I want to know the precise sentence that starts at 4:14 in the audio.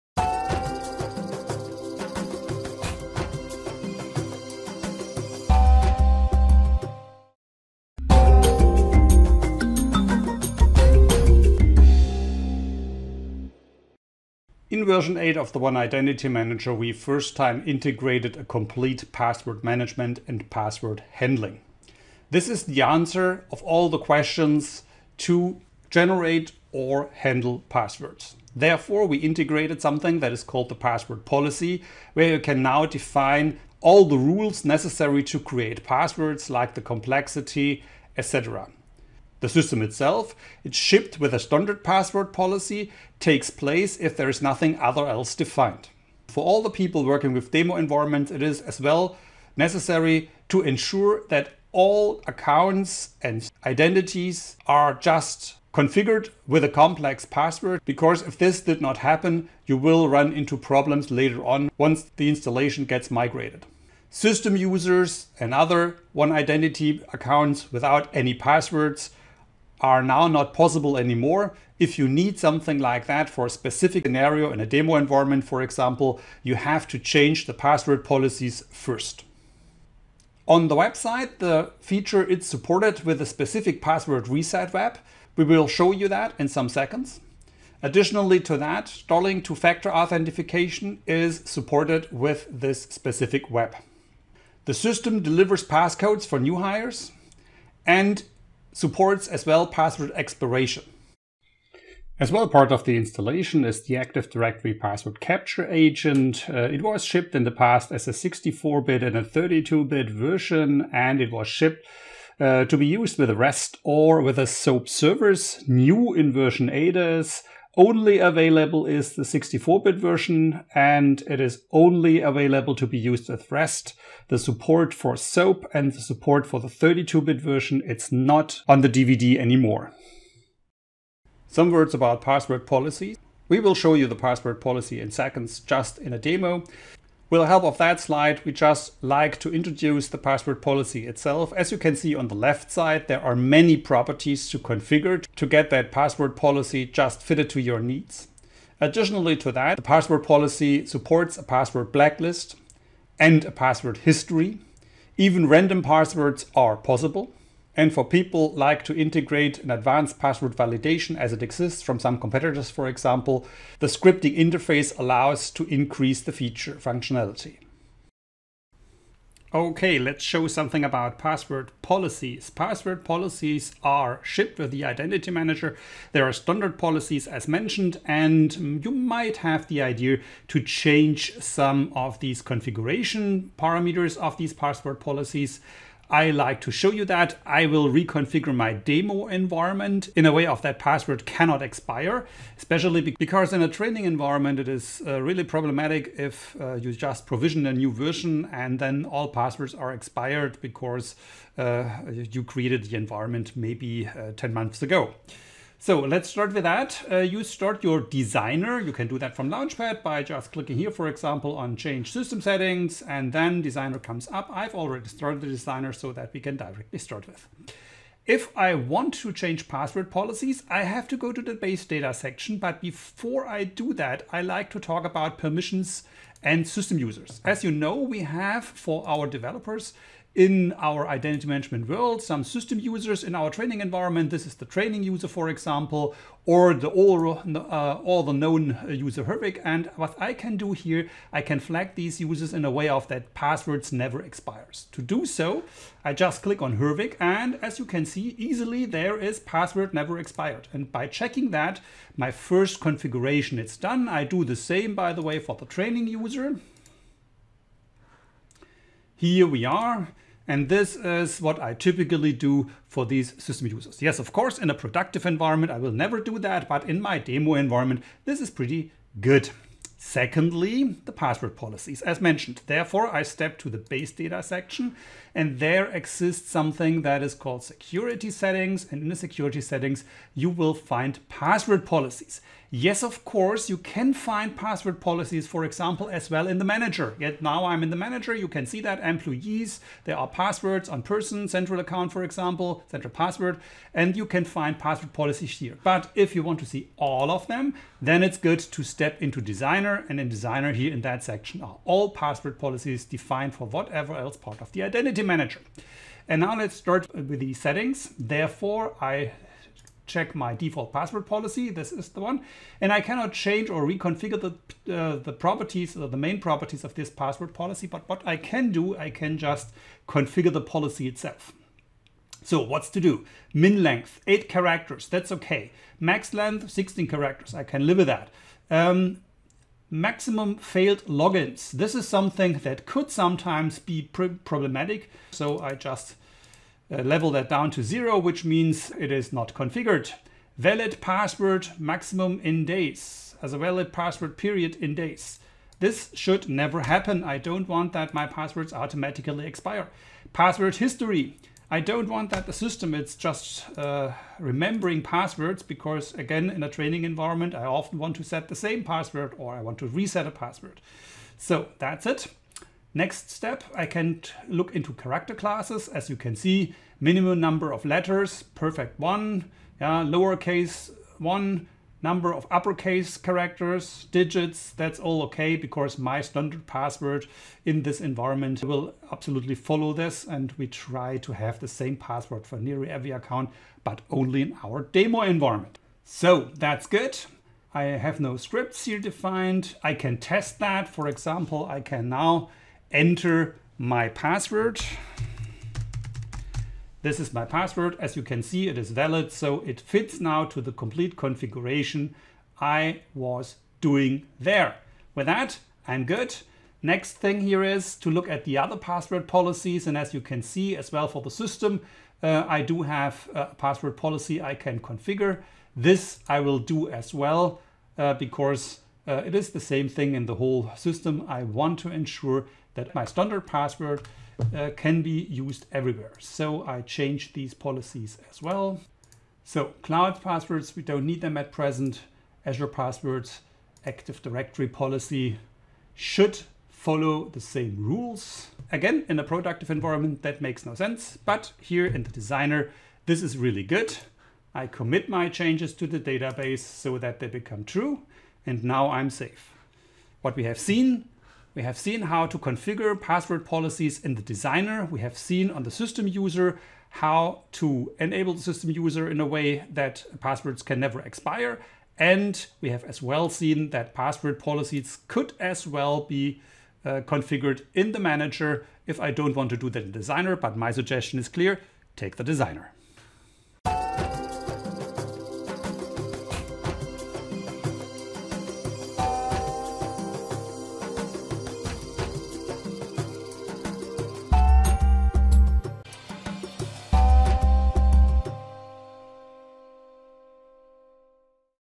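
I do the same, by the way, for the training user here we are.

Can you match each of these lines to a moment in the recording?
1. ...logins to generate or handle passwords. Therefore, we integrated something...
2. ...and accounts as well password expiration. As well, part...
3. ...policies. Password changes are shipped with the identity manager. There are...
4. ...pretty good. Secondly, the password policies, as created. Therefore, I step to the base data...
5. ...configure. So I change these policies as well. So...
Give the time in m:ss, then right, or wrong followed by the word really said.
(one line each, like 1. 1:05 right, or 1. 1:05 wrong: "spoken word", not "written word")
1. 0:23 wrong: "questions", not "logins"
2. 1:37 wrong: "supports", not "accounts"
3. 2:51 wrong: "policies", not "changes"
4. 4:28 wrong: "mentioned", not "created"
5. 7:05 wrong: "everywhere", not "configure".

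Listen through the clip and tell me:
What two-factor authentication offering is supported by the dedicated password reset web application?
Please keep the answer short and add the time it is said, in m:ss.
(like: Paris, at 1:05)
Starling, at 1:28.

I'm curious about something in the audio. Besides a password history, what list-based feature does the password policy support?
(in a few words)
Password blacklist.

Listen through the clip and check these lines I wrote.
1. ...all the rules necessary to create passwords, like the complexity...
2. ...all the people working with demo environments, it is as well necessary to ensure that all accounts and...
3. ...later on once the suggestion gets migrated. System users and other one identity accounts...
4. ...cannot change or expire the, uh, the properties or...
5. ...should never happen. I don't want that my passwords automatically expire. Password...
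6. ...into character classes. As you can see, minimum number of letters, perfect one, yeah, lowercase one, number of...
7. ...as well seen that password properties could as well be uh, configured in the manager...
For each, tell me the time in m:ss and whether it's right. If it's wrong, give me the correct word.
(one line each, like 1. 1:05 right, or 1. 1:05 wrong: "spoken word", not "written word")
1. 0:33 right
2. 0:46 right
3. 1:01 wrong: "installation", not "suggestion"
4. 5:13 wrong: "reconfigure", not "expire"
5. 5:46 right
6. 6:04 right
7. 7:42 wrong: "policies", not "properties".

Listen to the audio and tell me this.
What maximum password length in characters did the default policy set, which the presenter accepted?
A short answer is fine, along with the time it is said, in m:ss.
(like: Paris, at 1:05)
16, at 5:26.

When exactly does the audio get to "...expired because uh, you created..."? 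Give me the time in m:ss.
3:19.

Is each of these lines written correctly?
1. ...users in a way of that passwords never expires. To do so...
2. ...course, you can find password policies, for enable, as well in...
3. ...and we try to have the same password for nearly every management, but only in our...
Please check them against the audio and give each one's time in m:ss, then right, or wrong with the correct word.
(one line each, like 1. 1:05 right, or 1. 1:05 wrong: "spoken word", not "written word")
1. 4:02 right
2. 4:43 wrong: "example", not "enable"
3. 6:20 wrong: "account", not "management".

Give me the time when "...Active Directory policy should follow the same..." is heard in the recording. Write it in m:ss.
7:13.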